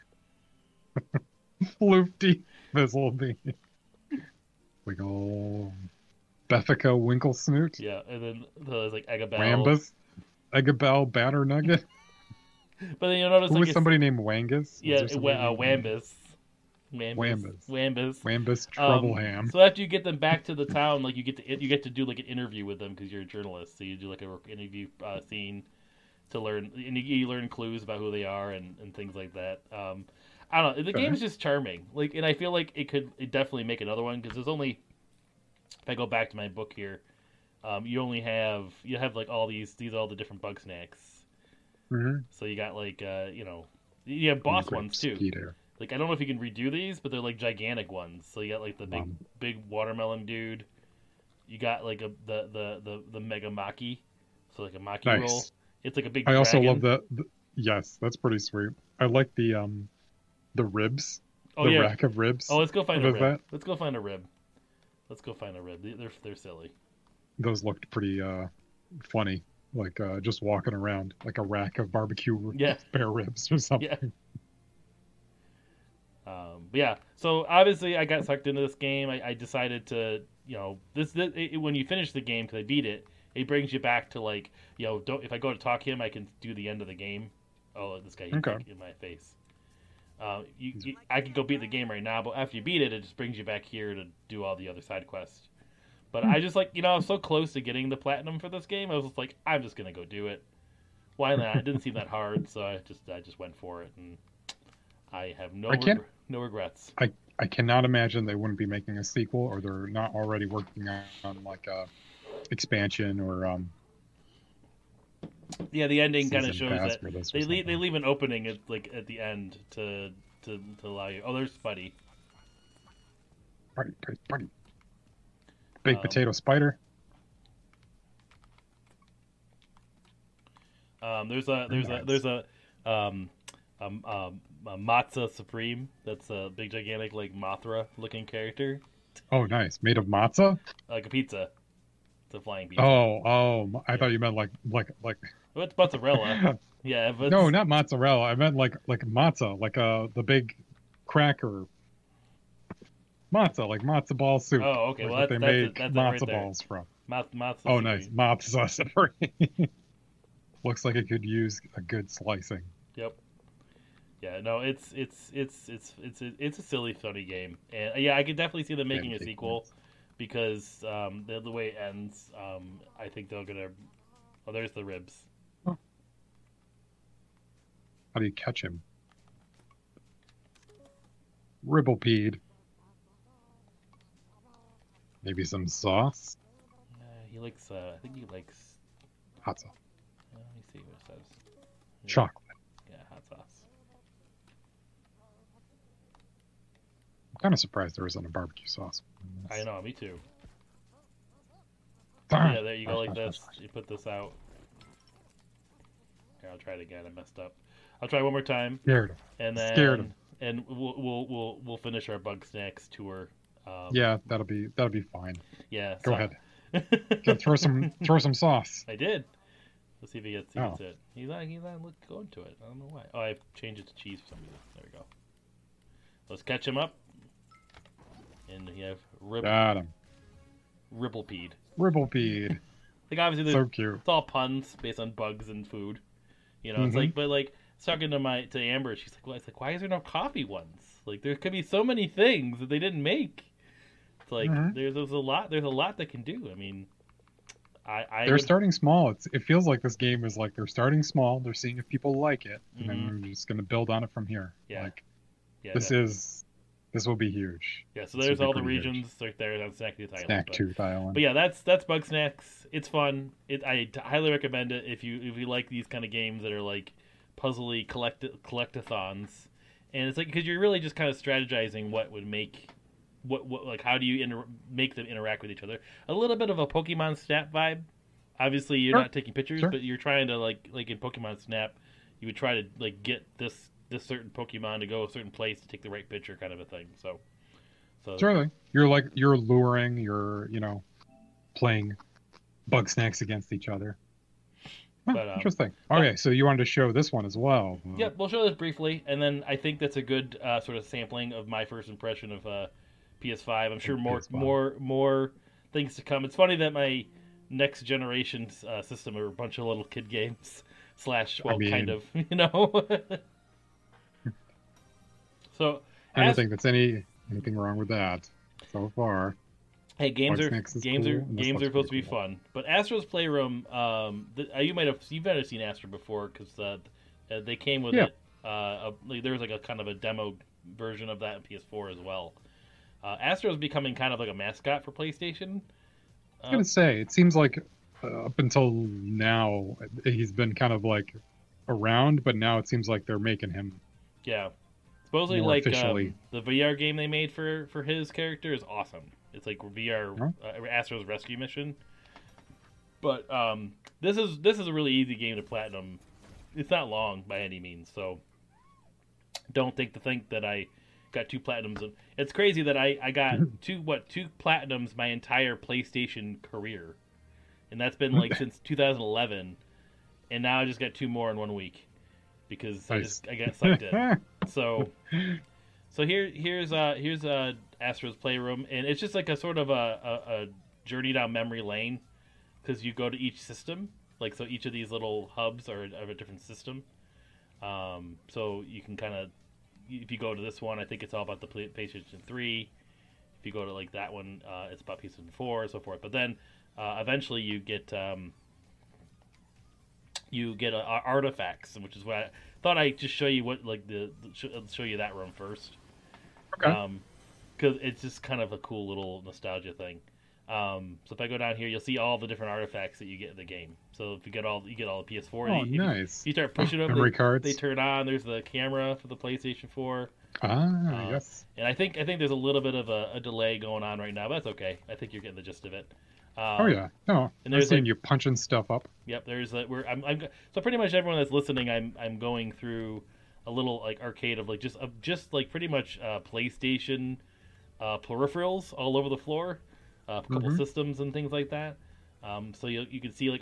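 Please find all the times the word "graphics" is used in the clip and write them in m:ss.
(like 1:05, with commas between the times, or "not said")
not said.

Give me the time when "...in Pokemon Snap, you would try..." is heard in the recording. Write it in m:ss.
4:40.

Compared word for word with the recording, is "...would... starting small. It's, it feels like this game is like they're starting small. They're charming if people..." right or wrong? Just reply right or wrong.
wrong.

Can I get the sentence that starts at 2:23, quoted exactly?
thought you meant like like like.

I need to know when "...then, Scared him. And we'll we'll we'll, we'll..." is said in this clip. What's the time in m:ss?
3:29.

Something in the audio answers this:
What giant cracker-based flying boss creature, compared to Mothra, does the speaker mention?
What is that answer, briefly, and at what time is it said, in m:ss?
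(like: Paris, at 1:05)
Matza Supreme, at 2:14.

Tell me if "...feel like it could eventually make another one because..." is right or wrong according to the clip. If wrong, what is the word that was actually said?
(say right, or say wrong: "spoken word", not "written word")
wrong: "definitely", not "eventually".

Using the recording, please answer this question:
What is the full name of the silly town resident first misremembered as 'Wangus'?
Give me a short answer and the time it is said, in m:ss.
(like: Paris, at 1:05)
Wambus Troubleham, at 0:18.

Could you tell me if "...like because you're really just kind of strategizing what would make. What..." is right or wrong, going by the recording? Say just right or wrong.
right.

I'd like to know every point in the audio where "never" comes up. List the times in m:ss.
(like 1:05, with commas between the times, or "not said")
5:25.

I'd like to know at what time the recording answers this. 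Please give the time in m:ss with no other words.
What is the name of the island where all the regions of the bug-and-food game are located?
4:19.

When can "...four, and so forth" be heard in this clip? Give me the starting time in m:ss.
6:35.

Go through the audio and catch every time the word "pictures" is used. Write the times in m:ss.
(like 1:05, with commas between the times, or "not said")
4:39, 4:46.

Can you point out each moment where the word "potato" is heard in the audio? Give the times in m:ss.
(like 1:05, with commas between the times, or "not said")
2:06.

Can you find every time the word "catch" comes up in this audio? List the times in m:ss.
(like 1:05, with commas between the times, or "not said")
2:58, 3:46.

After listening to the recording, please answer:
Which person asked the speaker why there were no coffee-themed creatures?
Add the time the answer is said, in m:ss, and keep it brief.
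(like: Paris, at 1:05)
Amber, at 3:58.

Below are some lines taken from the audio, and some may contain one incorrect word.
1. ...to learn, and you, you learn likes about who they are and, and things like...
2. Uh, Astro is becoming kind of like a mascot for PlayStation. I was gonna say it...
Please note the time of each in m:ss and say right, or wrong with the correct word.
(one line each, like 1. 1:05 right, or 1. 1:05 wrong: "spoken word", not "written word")
1. 0:26 wrong: "clues", not "likes"
2. 5:33 right.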